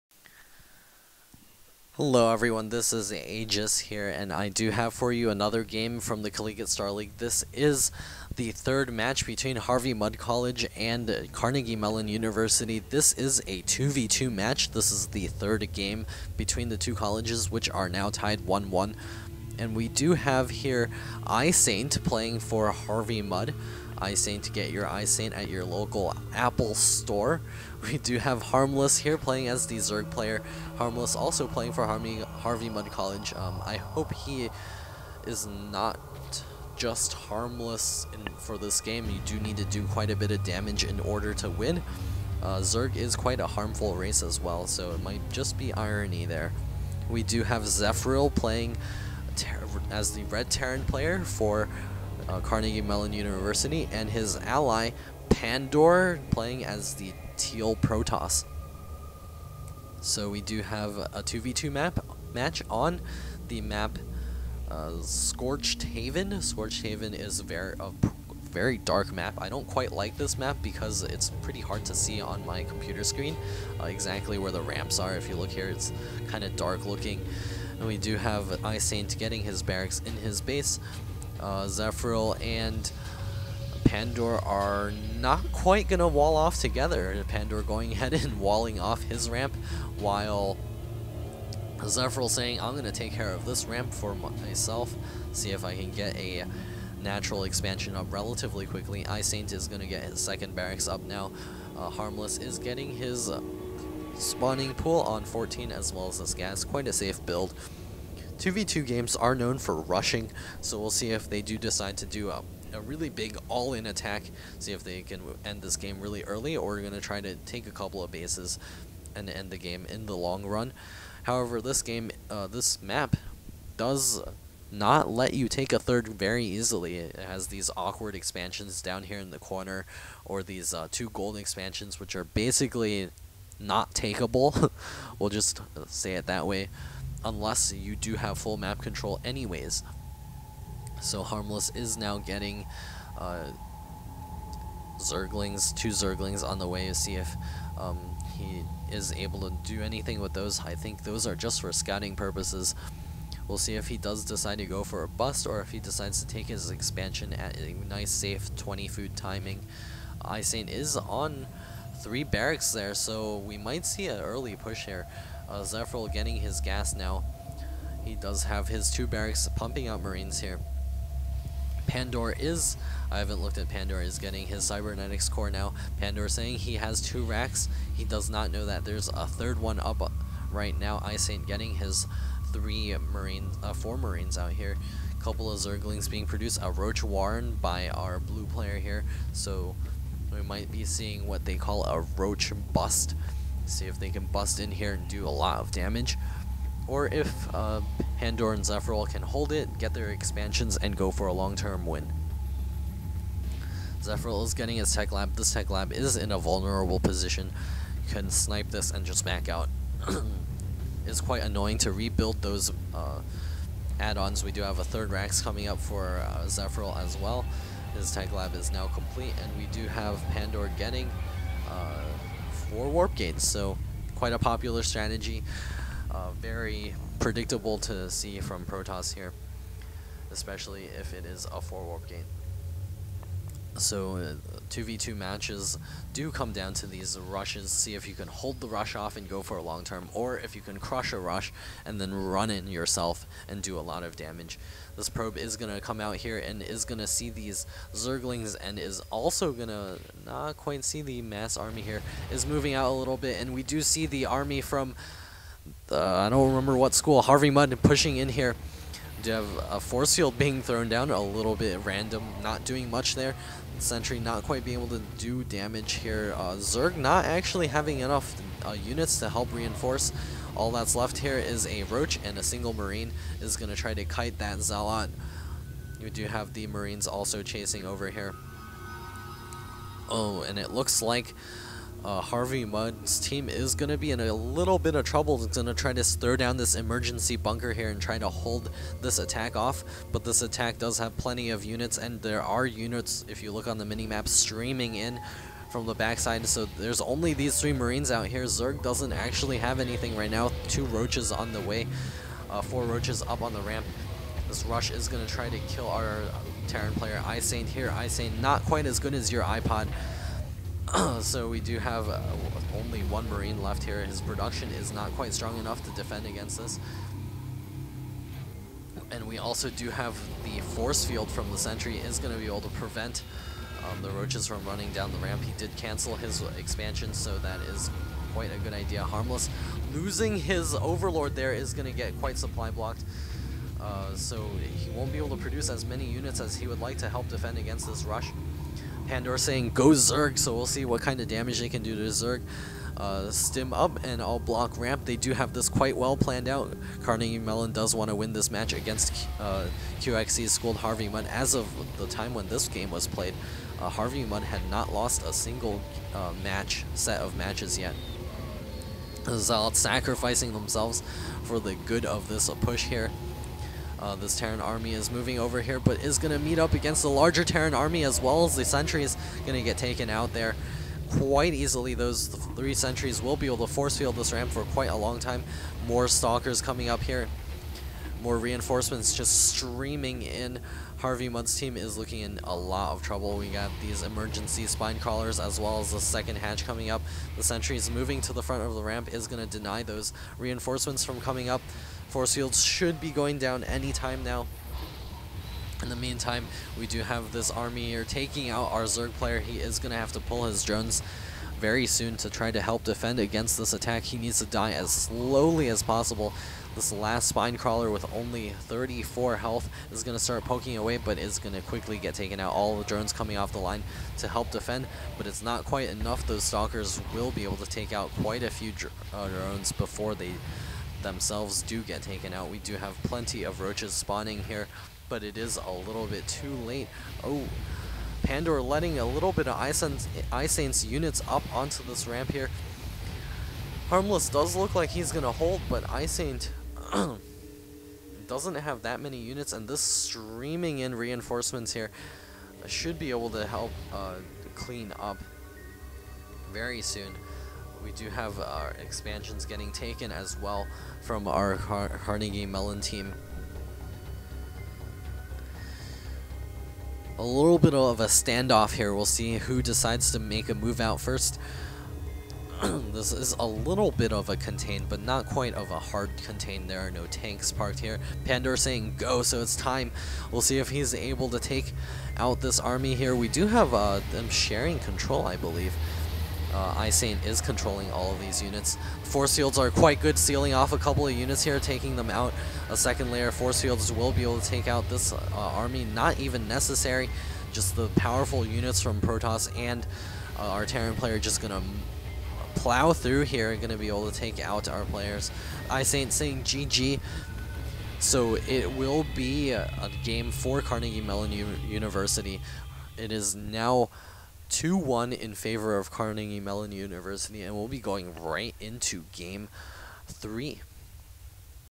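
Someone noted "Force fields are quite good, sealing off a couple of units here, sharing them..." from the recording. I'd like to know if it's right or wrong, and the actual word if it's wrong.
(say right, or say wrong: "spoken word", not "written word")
wrong: "taking", not "sharing".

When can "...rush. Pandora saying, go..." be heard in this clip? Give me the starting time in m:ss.
5:38.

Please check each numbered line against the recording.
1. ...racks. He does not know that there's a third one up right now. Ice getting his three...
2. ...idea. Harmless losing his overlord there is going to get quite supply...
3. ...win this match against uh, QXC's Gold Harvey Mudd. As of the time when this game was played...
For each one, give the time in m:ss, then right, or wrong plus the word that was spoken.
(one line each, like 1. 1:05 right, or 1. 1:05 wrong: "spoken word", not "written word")
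1. 2:57 right
2. 5:28 right
3. 5:48 right.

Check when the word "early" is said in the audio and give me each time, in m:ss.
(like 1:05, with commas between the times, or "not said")
1:56, 2:44.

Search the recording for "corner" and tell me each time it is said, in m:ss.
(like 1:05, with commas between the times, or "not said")
2:09.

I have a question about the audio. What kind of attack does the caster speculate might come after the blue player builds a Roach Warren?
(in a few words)
Roach Bust.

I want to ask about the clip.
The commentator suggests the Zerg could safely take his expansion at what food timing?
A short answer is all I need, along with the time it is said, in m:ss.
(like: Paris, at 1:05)
20, at 2:38.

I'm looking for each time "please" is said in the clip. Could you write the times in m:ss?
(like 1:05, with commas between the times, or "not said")
not said.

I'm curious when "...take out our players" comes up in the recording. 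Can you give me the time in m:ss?
8:14.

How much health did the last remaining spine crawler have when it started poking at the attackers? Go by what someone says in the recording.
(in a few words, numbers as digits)
34.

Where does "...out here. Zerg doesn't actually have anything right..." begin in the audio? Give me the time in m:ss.
4:58.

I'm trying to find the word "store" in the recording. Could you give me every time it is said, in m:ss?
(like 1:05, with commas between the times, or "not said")
0:26.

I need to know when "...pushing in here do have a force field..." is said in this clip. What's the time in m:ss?
4:17.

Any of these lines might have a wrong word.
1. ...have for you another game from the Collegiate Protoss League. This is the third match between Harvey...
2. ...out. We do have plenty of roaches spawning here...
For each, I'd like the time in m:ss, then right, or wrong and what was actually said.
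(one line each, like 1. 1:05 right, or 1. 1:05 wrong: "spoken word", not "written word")
1. 0:04 wrong: "Star", not "Protoss"
2. 7:02 right.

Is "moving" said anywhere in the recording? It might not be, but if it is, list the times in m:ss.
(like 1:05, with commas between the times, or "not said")
4:12, 6:05, 6:27.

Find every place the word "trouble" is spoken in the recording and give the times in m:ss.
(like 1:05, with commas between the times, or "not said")
4:45, 6:23.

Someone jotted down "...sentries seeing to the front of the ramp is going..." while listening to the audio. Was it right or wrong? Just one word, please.
wrong.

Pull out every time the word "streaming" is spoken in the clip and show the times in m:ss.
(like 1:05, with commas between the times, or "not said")
4:54, 6:19, 7:19.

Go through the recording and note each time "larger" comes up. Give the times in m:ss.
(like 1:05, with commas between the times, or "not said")
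6:07.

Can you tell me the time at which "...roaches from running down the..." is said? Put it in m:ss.
5:24.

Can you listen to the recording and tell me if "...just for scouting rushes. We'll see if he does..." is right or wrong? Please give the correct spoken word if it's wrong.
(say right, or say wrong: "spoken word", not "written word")
wrong: "purposes", not "rushes".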